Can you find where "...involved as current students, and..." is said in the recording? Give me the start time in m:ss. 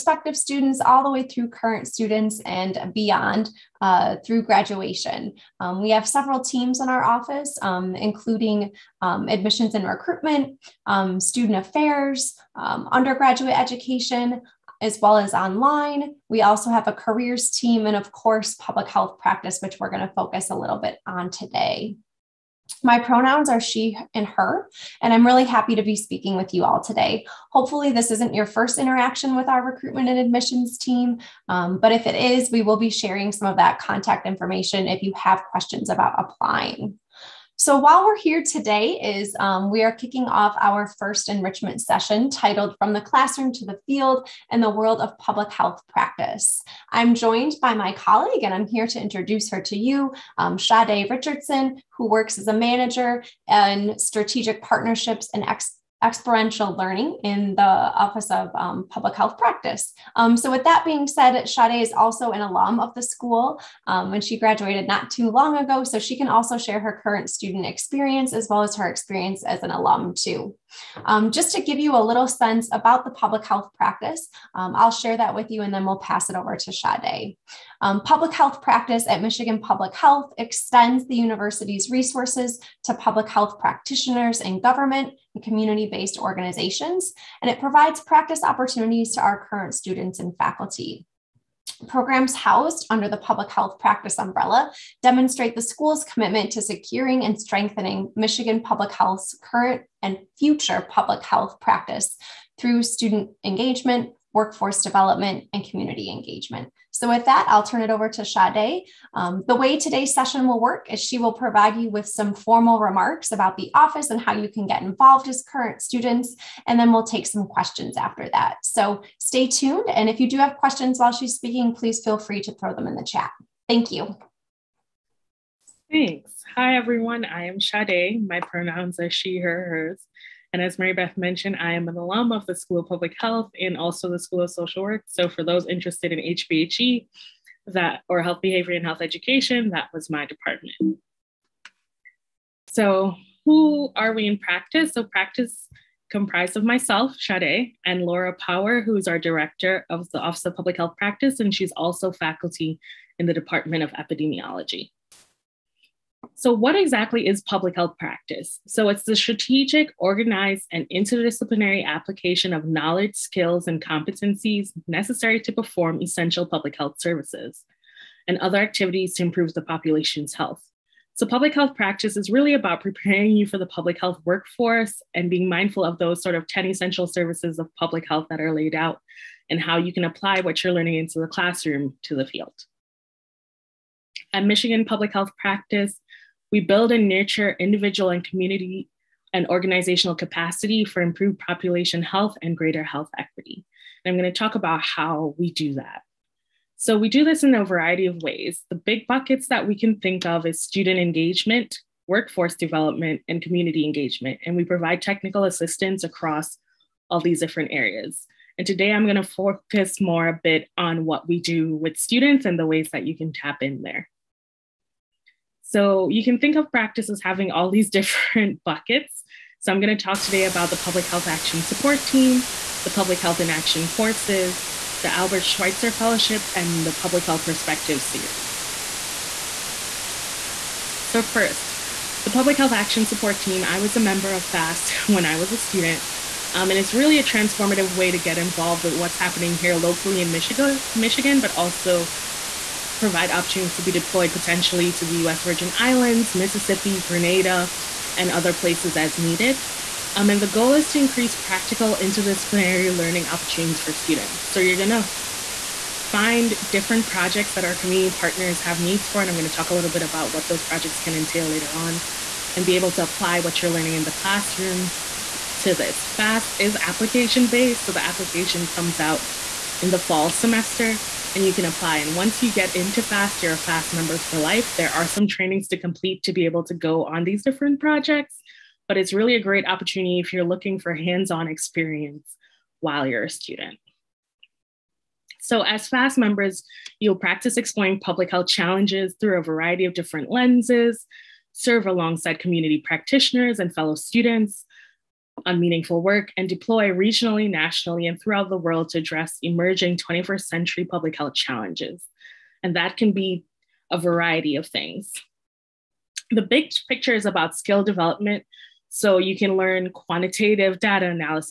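1:54.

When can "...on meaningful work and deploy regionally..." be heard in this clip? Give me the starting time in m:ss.
4:55.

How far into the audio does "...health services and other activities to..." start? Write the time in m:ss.
2:46.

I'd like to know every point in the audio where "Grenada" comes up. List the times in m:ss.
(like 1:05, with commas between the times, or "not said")
4:07.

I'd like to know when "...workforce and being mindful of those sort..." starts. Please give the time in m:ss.
2:54.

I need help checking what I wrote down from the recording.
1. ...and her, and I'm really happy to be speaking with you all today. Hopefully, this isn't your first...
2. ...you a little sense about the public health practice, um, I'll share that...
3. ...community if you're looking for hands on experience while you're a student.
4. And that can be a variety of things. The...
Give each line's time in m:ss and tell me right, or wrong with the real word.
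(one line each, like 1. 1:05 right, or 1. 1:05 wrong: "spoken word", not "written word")
1. 0:24 right
2. 1:11 right
3. 4:39 wrong: "opportunity", not "community"
4. 5:02 right.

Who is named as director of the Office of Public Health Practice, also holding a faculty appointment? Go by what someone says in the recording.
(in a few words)
Laura Power.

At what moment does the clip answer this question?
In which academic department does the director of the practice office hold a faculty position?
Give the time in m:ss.
2:33.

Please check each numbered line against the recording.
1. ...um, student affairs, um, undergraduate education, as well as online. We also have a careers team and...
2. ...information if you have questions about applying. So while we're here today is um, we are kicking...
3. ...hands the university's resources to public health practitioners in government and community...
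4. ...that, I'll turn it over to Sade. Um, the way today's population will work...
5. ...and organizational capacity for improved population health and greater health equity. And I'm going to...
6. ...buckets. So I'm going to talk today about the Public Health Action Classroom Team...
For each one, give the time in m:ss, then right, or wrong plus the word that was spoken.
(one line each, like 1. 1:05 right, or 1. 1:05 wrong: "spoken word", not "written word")
1. 0:10 right
2. 0:34 right
3. 1:20 wrong: "extends", not "hands"
4. 1:47 wrong: "session", not "population"
5. 3:09 right
6. 3:38 wrong: "Support", not "Classroom".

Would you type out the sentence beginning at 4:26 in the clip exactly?
PHAST is application-based, so the application comes out in the fall semester and you can apply.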